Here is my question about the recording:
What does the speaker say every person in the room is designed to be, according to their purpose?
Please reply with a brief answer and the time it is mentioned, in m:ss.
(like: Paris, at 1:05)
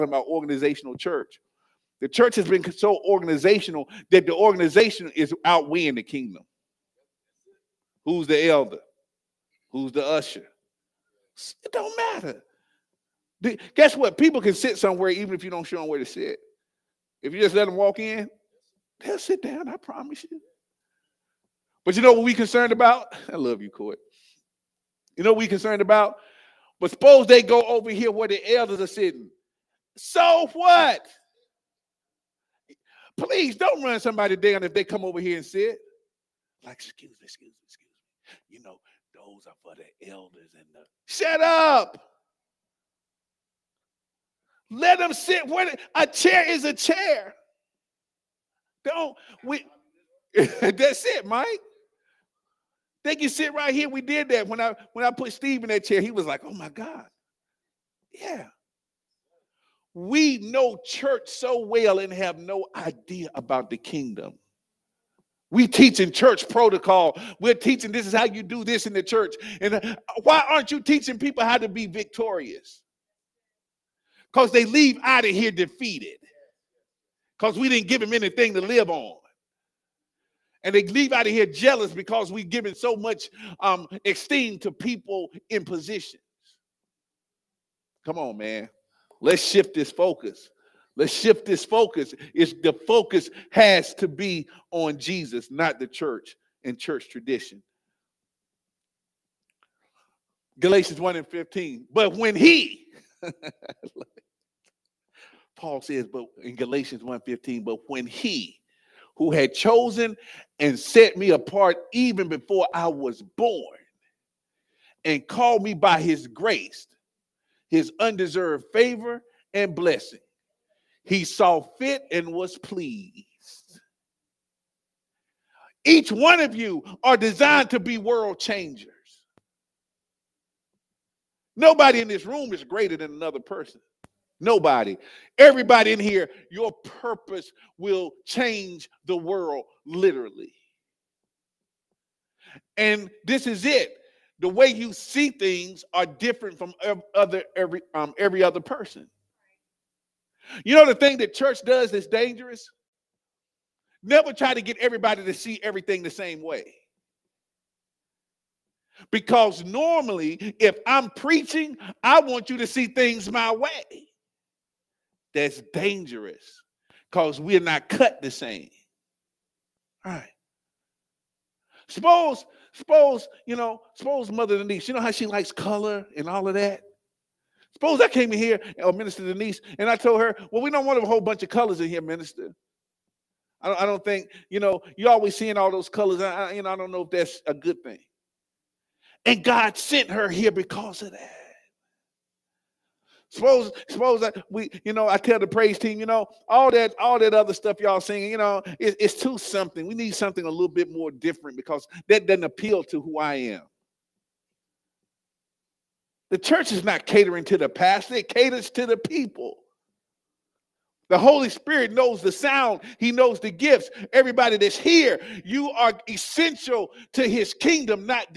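World changers, at 2:07.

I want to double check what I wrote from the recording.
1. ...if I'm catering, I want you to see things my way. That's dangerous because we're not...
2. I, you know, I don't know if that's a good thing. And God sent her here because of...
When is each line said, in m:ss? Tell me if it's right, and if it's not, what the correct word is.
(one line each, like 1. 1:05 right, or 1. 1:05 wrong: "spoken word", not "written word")
1. 2:40 wrong: "preaching", not "catering"
2. 3:06 right.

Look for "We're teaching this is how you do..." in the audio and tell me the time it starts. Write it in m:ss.
1:07.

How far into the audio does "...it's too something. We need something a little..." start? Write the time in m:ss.
3:19.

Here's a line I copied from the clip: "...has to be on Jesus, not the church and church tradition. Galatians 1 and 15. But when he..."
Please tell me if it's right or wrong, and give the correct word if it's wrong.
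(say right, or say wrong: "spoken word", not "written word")
right.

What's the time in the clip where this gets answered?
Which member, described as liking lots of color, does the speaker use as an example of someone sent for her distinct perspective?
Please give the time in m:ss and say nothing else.
2:58.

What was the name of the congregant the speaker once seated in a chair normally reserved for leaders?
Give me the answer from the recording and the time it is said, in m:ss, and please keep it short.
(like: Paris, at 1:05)
Steve, at 0:55.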